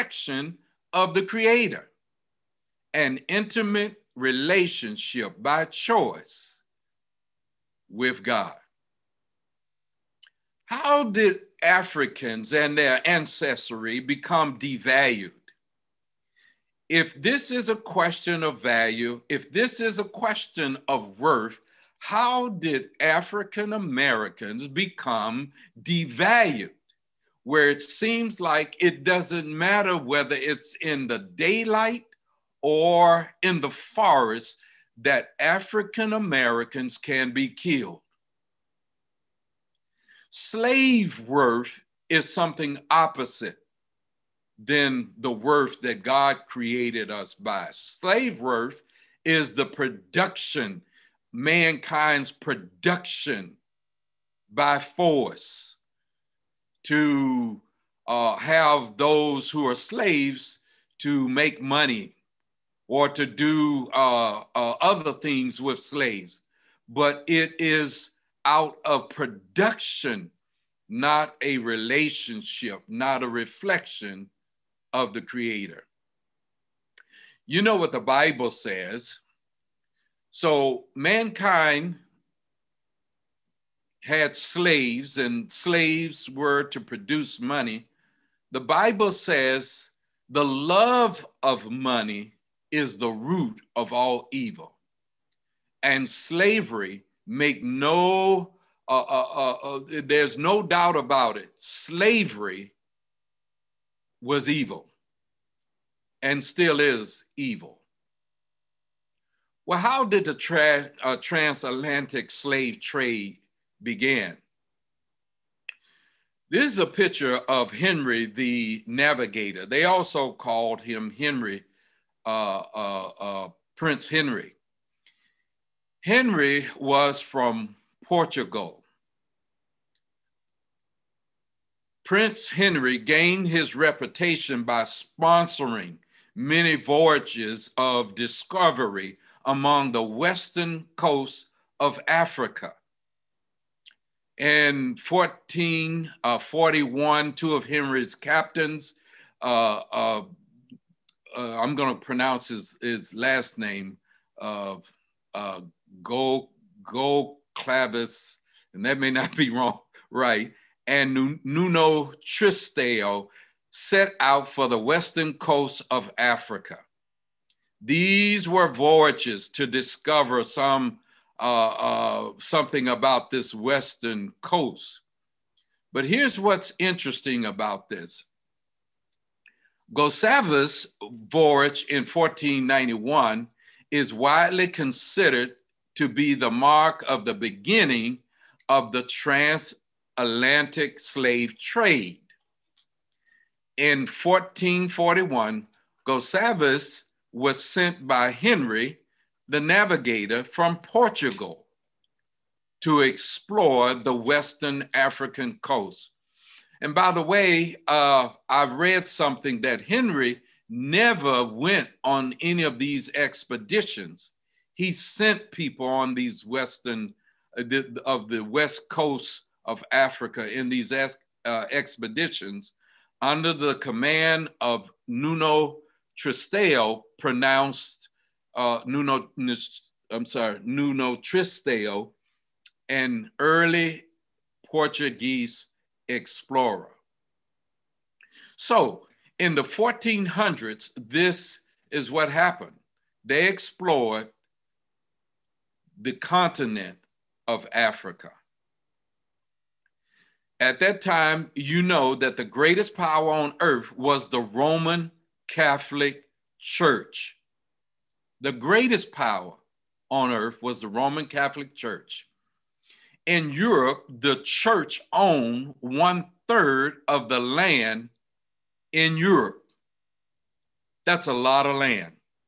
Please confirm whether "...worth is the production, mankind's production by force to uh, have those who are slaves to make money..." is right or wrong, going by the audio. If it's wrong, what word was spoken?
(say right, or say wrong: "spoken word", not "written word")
right.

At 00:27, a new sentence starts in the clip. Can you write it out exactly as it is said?
Where it seems like it doesn't matter whether it's in the daylight or in the forest that African Americans can be killed.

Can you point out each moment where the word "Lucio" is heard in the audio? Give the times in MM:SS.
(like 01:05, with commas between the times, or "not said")
not said.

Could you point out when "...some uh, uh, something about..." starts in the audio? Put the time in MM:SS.
02:50.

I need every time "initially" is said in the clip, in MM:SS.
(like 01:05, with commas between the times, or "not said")
not said.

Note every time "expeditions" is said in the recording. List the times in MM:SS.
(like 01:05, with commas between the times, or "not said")
03:33, 03:41.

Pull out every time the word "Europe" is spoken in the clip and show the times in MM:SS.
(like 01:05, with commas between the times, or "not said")
04:23, 04:29.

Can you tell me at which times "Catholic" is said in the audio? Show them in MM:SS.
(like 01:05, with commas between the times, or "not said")
04:15, 04:21.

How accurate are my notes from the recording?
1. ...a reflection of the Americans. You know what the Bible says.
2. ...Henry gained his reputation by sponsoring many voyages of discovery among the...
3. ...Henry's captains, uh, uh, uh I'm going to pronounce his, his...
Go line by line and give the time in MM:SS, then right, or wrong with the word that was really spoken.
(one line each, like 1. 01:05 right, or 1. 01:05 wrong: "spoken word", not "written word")
1. 01:13 wrong: "Creator", not "Americans"
2. 02:12 right
3. 02:27 right.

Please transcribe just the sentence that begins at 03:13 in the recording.
In 1441, Gustavus was sent by Henry, the navigator, from Portugal to explore the Western African coast.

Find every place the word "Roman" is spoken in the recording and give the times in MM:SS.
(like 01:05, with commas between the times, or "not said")
04:14, 04:20.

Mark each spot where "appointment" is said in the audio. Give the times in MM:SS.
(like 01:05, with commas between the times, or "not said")
not said.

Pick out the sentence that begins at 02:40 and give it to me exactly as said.
And Nuno Tristeo set out for the western coast of Africa.